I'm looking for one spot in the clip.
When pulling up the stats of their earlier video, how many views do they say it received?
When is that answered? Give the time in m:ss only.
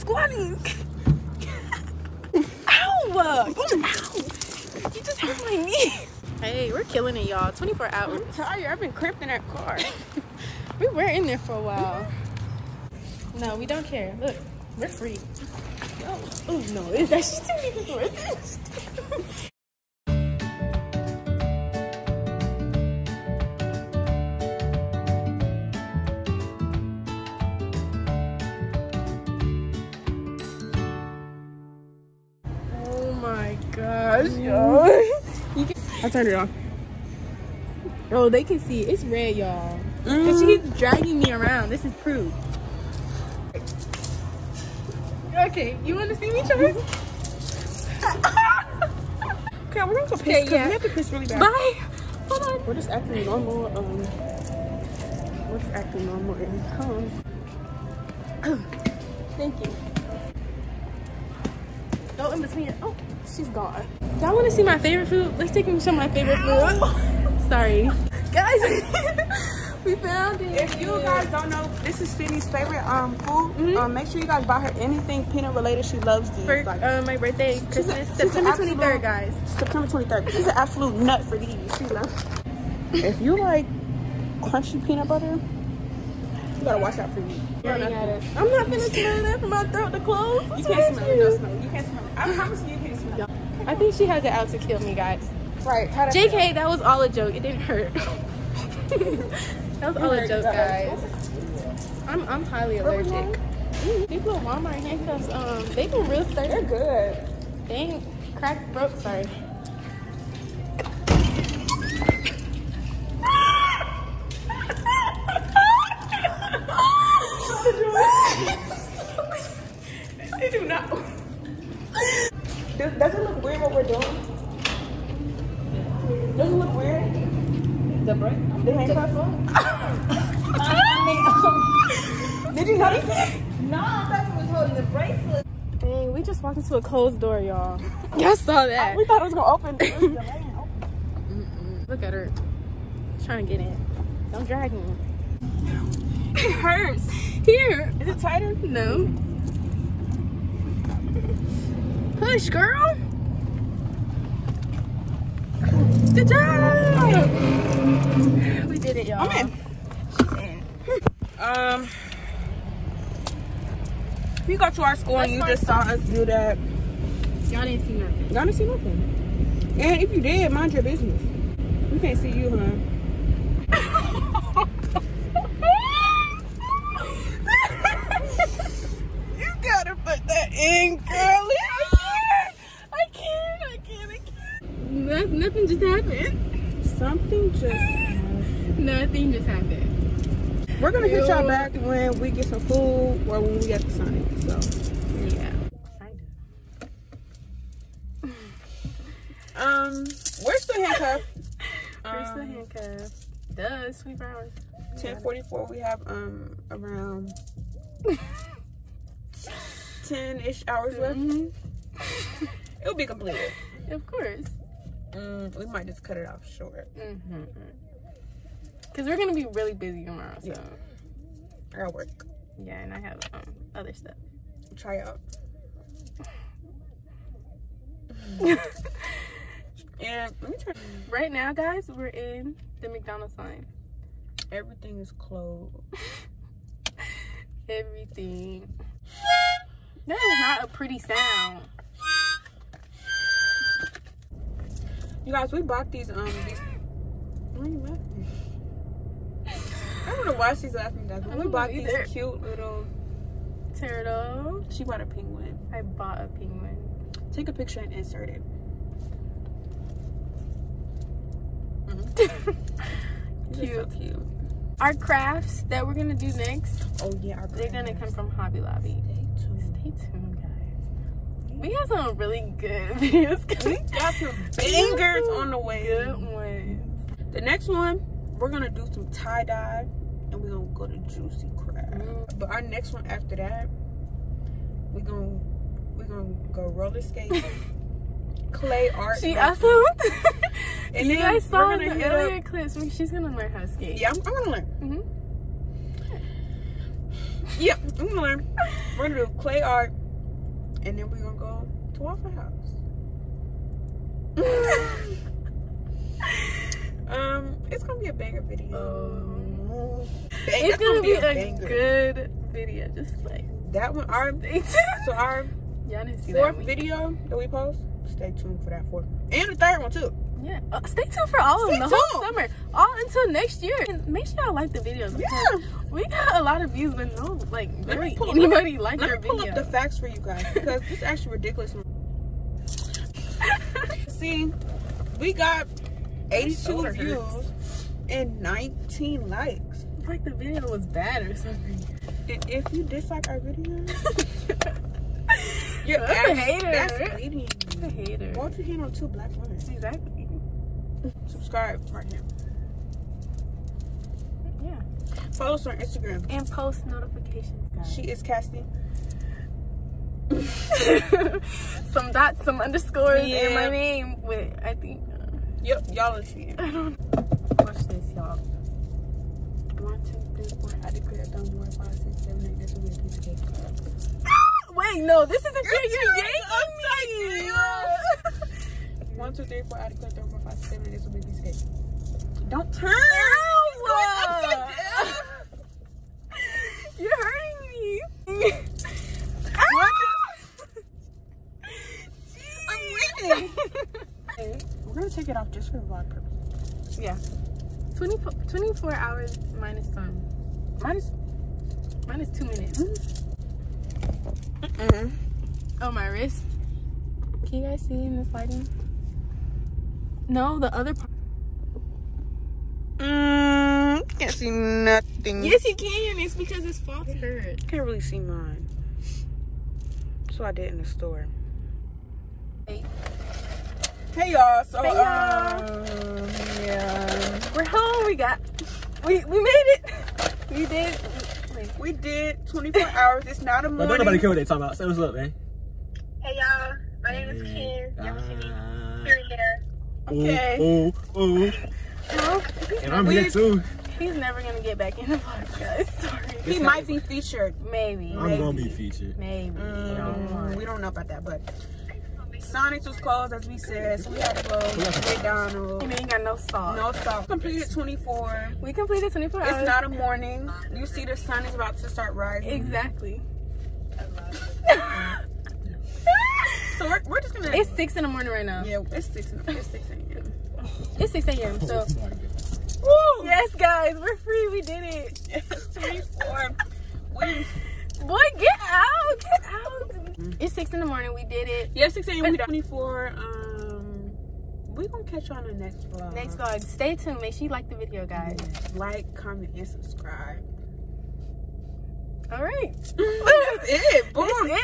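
5:36.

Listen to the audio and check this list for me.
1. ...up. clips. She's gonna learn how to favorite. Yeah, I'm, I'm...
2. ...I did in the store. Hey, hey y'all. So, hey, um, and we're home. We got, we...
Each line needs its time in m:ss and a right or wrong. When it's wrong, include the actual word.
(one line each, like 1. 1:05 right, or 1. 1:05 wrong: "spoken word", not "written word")
1. 4:52 wrong: "skate", not "favorite"
2. 7:00 right.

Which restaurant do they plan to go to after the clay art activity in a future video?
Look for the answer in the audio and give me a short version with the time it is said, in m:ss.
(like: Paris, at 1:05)
Waffle House, at 5:02.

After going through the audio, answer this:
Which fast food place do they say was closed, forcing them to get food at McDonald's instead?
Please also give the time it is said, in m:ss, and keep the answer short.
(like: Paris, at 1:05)
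Sonic, at 7:32.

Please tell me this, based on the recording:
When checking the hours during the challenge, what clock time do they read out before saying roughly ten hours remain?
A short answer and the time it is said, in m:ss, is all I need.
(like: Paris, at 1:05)
10:44, at 3:24.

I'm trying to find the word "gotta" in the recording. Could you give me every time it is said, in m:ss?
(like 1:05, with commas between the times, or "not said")
1:26, 2:59.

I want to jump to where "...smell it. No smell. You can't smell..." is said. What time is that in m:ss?
1:30.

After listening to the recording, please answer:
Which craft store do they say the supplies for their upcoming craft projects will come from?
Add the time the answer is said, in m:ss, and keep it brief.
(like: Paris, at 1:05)
Hobby Lobby, at 4:28.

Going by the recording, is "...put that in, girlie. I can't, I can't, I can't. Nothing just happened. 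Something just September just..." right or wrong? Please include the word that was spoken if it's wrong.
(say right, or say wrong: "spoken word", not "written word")
wrong: "Nothing", not "September".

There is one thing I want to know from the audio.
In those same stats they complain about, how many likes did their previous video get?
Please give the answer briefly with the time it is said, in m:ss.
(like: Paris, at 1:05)
19, at 5:38.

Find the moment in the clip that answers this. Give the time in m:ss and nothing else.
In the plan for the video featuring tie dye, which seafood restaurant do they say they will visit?
4:41.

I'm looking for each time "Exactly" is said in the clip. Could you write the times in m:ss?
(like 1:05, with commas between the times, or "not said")
5:49, 7:42.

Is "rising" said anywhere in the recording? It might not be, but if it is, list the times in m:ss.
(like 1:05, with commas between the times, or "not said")
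7:42.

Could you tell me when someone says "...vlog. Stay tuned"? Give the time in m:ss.
8:06.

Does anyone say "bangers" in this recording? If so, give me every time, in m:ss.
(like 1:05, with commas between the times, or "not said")
4:34, 5:08.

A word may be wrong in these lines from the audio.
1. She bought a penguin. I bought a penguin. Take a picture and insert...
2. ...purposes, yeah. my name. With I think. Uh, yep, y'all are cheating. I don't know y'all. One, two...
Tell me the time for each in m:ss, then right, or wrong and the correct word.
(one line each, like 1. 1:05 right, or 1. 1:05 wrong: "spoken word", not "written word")
1. 4:14 right
2. 6:02 wrong: "underscores", not "purposes".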